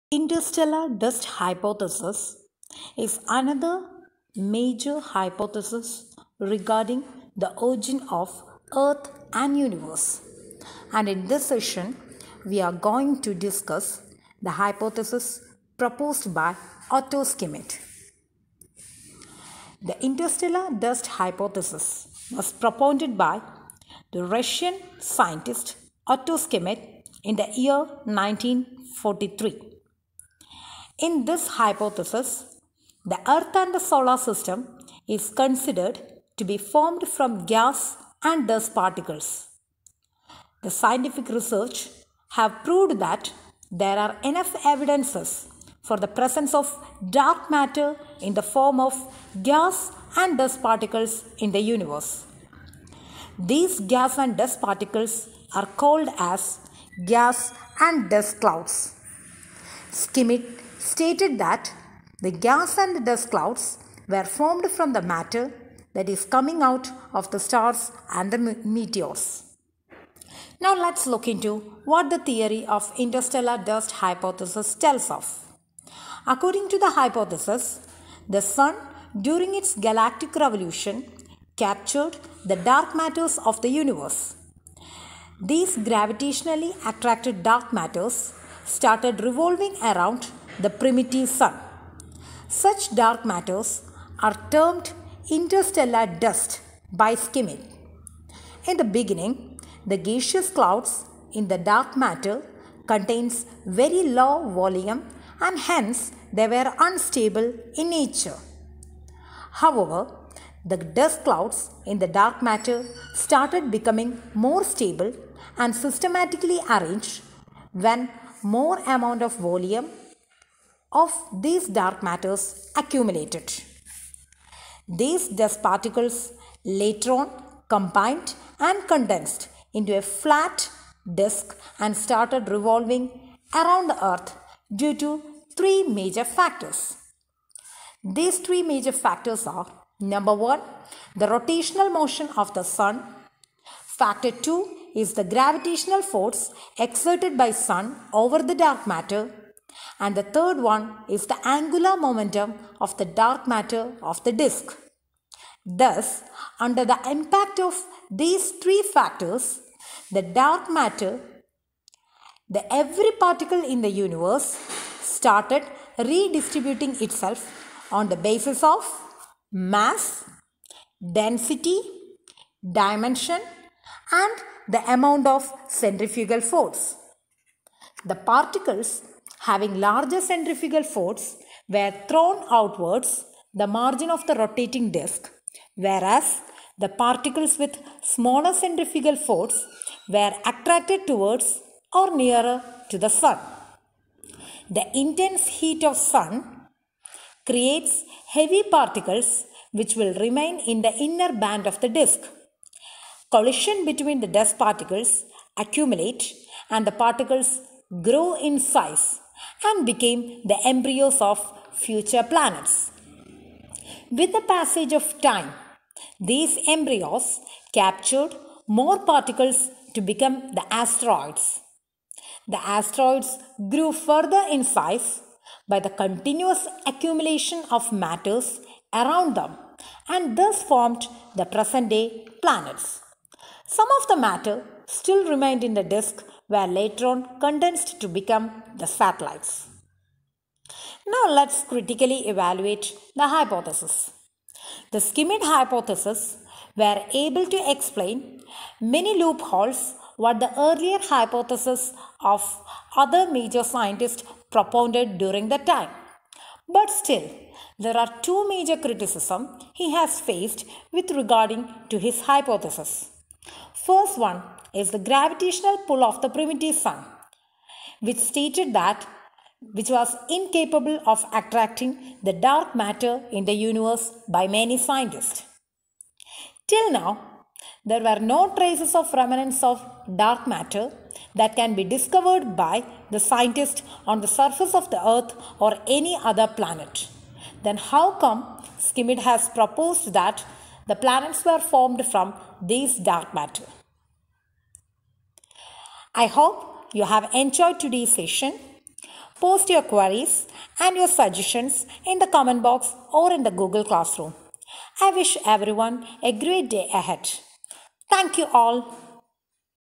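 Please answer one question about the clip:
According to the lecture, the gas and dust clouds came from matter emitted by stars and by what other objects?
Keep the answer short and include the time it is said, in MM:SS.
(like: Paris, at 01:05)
meteors, at 01:08.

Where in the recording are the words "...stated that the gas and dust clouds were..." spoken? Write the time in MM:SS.
01:00.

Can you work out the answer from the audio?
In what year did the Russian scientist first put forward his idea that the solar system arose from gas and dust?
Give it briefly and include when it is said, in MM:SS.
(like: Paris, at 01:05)
1943, at 00:28.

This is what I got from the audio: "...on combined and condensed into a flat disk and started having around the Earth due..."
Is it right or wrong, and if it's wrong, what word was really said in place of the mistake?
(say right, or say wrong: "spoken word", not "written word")
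wrong: "revolving", not "having".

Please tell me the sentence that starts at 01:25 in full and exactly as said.
These gravitationally attracted dark matters started revolving around the primitive sun.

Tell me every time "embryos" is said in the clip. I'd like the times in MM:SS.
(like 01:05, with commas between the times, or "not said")
03:30, 03:36.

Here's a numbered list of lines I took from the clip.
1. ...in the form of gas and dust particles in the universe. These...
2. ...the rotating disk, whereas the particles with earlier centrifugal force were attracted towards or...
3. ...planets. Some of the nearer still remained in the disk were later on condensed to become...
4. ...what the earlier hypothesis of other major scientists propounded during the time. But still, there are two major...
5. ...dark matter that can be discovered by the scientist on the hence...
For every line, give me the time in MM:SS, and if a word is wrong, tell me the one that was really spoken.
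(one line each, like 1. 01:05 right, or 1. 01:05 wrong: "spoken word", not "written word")
1. 00:48 right
2. 03:04 wrong: "smaller", not "earlier"
3. 03:52 wrong: "matter", not "nearer"
4. 04:10 right
5. 04:40 wrong: "surface", not "hence".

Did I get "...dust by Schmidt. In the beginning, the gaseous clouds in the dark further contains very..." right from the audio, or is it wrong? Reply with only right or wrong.
wrong.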